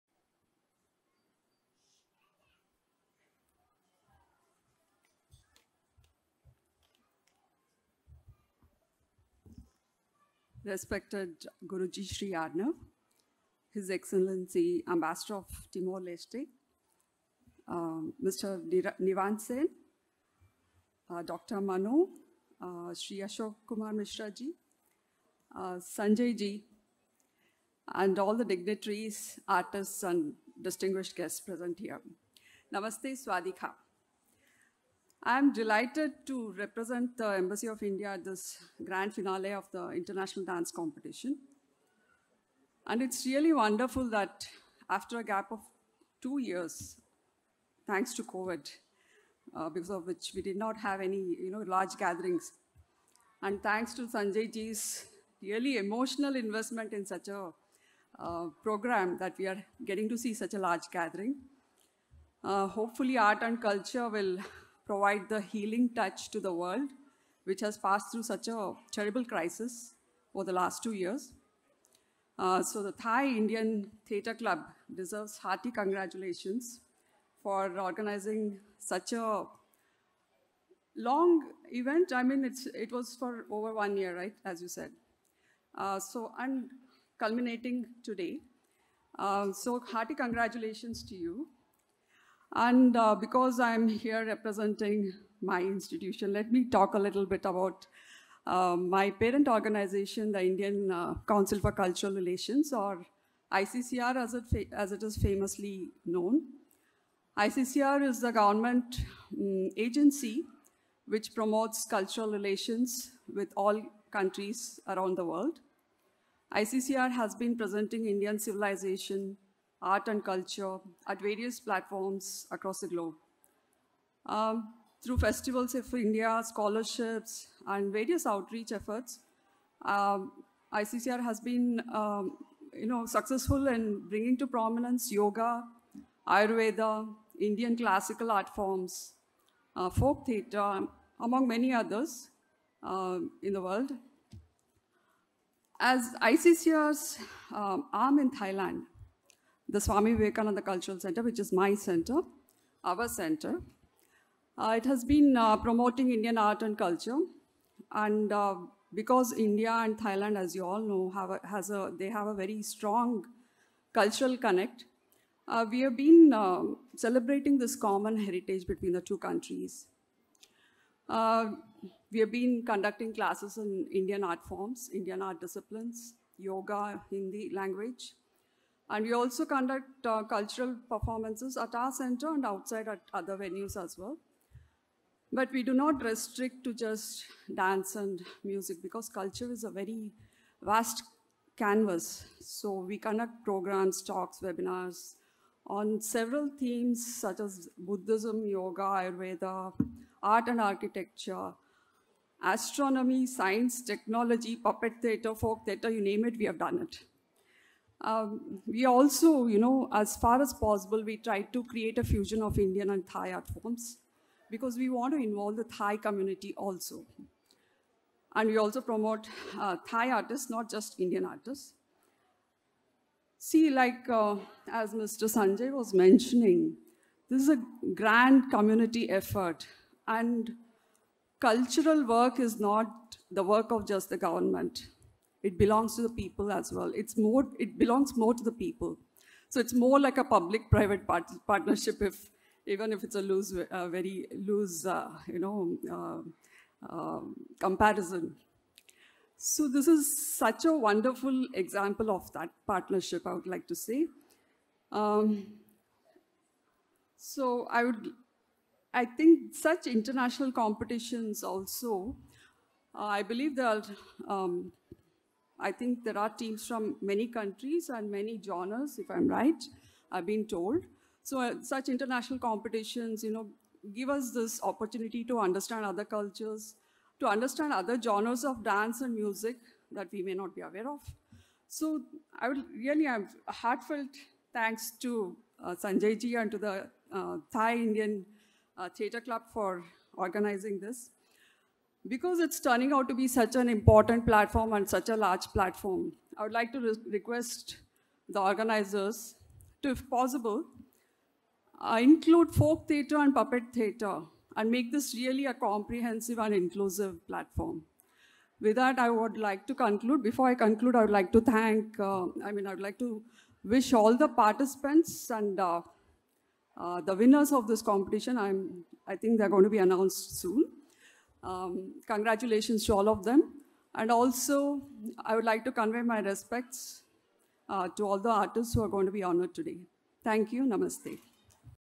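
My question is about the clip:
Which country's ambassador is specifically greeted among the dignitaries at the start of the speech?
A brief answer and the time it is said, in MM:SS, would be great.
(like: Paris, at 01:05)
Timor-Leste, at 00:15.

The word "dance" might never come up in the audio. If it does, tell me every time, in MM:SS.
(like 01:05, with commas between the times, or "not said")
00:40, 03:07, 04:38.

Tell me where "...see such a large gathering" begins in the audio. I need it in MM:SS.
01:00.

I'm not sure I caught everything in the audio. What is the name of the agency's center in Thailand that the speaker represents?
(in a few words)
Swami Vivekananda Cultural Center.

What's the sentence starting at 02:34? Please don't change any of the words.
Uh, it has been uh, promoting Indian art and culture.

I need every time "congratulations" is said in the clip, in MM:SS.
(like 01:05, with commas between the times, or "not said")
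01:15, 01:30, 05:22.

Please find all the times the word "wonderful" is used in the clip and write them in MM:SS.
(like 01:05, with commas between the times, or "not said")
00:43, 04:10.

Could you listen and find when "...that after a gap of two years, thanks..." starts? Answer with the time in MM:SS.
00:44.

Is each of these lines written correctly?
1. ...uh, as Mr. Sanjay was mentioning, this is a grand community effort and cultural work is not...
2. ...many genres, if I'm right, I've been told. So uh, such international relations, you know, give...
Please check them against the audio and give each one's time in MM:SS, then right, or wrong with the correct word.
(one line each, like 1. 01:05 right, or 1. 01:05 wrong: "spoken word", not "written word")
1. 03:44 right
2. 04:28 wrong: "competitions", not "relations".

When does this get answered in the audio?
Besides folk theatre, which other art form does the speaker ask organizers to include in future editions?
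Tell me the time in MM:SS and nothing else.
05:03.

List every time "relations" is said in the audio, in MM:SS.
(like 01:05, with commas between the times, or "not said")
01:42, 01:52.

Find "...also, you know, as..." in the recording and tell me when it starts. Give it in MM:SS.
03:28.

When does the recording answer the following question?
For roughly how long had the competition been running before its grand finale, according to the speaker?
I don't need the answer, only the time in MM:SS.
01:23.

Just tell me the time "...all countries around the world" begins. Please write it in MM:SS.
01:53.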